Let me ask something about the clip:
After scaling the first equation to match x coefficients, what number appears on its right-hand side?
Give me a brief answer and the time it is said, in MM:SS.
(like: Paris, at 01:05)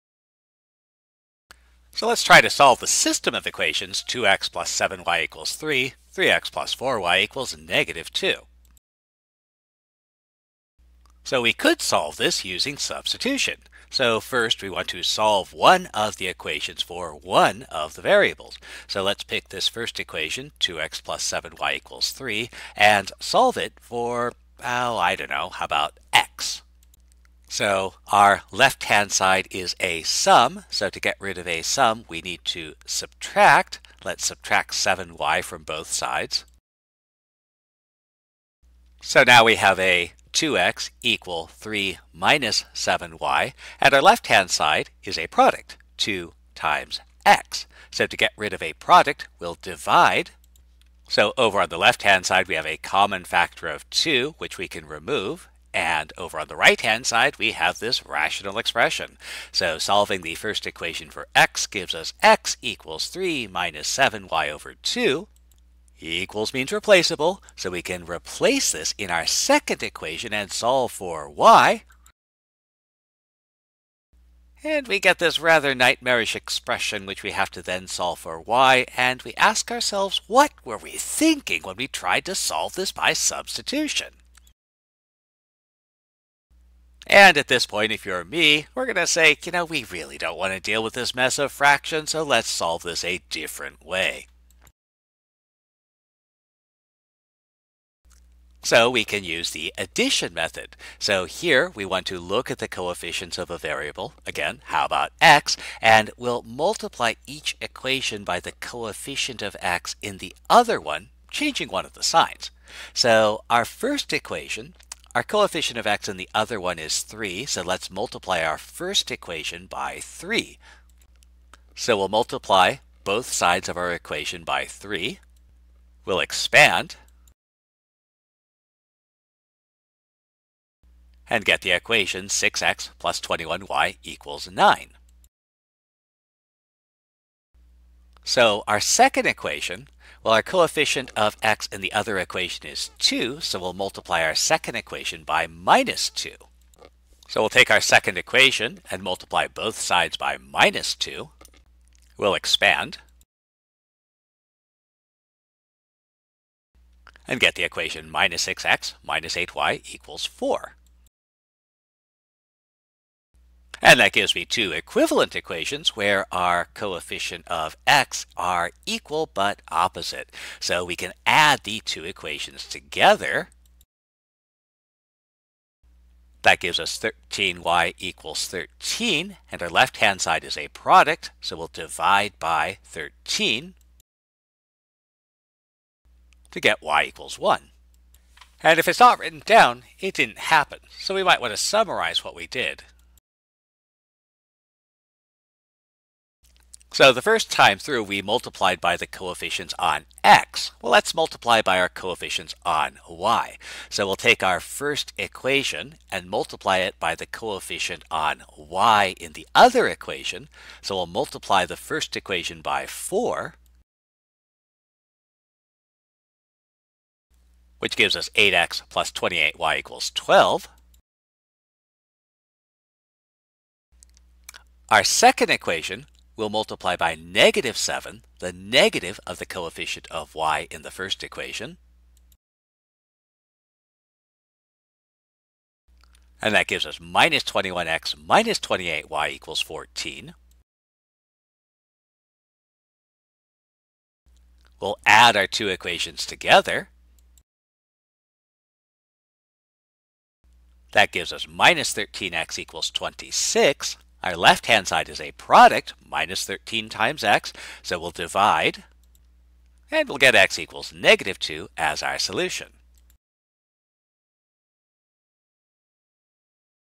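9, at 02:14.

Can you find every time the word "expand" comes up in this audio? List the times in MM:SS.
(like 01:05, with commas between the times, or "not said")
02:06, 02:32.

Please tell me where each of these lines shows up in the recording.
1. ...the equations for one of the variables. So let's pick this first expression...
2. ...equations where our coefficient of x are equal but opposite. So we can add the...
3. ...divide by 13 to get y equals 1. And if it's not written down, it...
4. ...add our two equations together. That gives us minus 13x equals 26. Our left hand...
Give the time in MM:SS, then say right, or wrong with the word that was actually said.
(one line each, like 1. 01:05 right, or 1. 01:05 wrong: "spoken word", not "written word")
1. 00:16 wrong: "equation", not "expression"
2. 02:45 right
3. 03:01 right
4. 04:05 right.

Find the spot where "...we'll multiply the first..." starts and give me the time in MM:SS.
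03:30.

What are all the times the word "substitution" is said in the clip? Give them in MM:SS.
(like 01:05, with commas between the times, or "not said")
00:12, 01:23.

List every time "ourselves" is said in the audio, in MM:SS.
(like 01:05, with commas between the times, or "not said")
01:19.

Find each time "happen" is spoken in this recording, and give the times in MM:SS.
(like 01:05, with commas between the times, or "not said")
03:10.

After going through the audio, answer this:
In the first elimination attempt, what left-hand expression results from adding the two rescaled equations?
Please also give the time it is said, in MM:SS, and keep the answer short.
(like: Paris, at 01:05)
13y, at 02:56.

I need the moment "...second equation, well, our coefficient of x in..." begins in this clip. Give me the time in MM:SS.
02:18.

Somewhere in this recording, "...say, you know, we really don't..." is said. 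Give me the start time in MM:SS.
01:29.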